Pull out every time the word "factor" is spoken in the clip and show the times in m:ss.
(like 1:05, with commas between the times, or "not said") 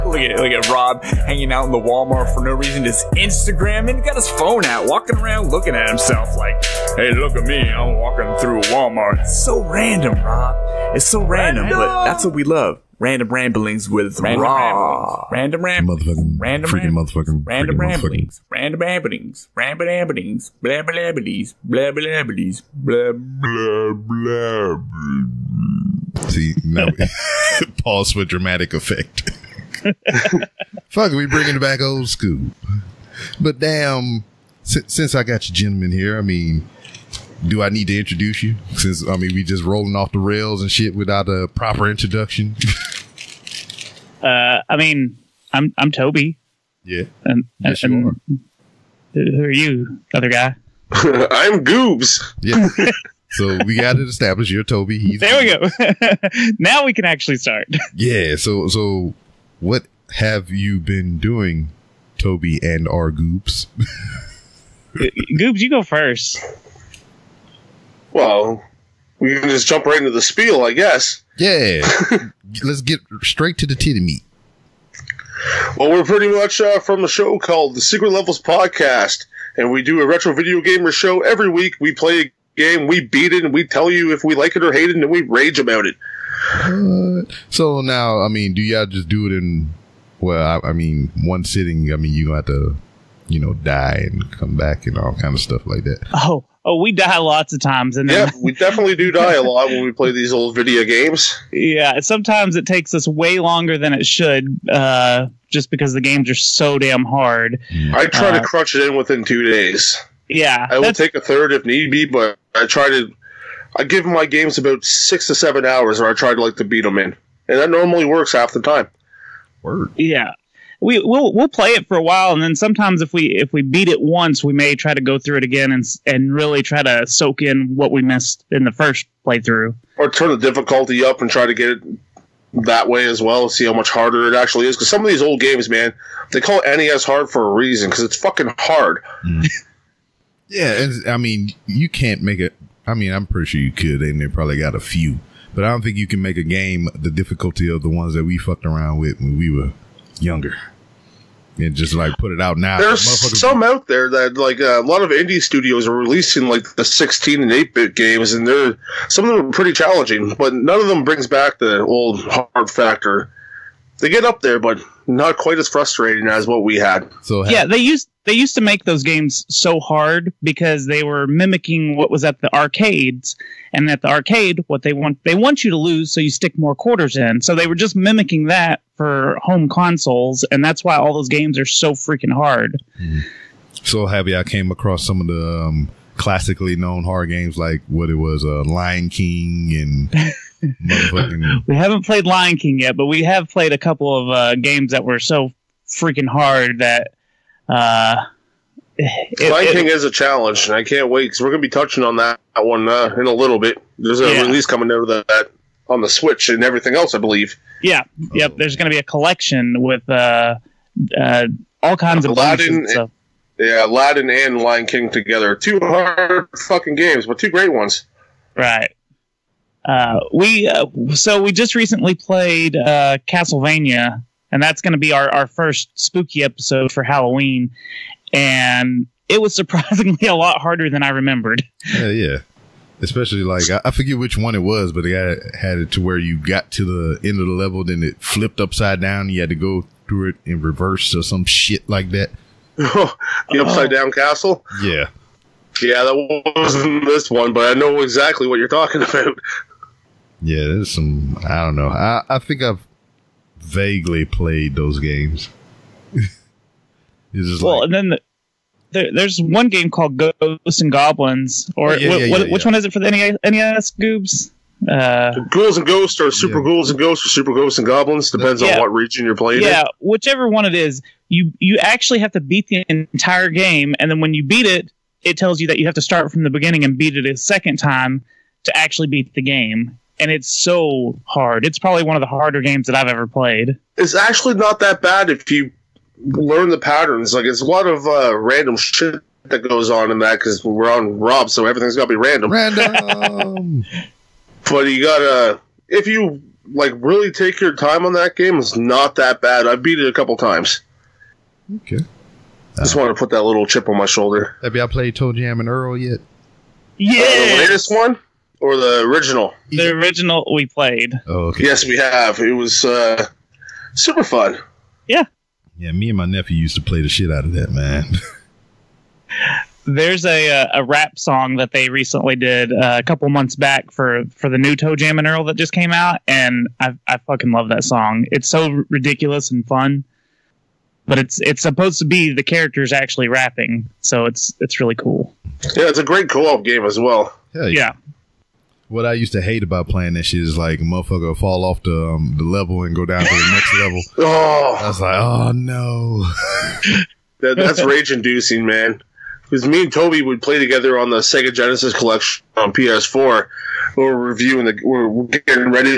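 2:42.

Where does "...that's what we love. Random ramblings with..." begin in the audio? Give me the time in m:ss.
0:12.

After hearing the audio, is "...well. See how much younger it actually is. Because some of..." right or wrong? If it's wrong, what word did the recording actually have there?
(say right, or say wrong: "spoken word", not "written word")
wrong: "harder", not "younger".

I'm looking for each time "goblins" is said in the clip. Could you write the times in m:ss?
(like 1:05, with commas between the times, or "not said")
4:20, 4:27.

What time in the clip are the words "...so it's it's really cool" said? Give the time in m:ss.
5:34.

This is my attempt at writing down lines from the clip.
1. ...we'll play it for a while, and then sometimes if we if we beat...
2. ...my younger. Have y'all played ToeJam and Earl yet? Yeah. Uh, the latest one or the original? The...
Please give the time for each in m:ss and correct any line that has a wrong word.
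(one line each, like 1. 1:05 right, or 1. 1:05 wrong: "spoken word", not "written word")
1. 2:01 right
2. 5:03 wrong: "shoulder", not "younger".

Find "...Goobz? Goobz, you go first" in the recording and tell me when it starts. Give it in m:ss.
1:03.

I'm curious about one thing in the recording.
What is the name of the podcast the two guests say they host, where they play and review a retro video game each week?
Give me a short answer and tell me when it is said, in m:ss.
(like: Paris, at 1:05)
Secret Levels Podcast, at 1:17.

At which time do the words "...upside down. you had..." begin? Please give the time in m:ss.
3:58.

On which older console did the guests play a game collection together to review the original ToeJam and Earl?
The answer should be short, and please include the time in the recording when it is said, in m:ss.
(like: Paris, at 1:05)
PS4, at 5:52.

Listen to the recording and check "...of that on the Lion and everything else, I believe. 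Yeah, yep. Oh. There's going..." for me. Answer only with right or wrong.
wrong.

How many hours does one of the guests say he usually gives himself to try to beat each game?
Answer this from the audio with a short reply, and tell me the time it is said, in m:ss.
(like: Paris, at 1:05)
6 to 7, at 1:54.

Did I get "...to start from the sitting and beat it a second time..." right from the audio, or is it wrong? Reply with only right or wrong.
wrong.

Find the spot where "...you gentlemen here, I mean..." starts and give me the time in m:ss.
0:35.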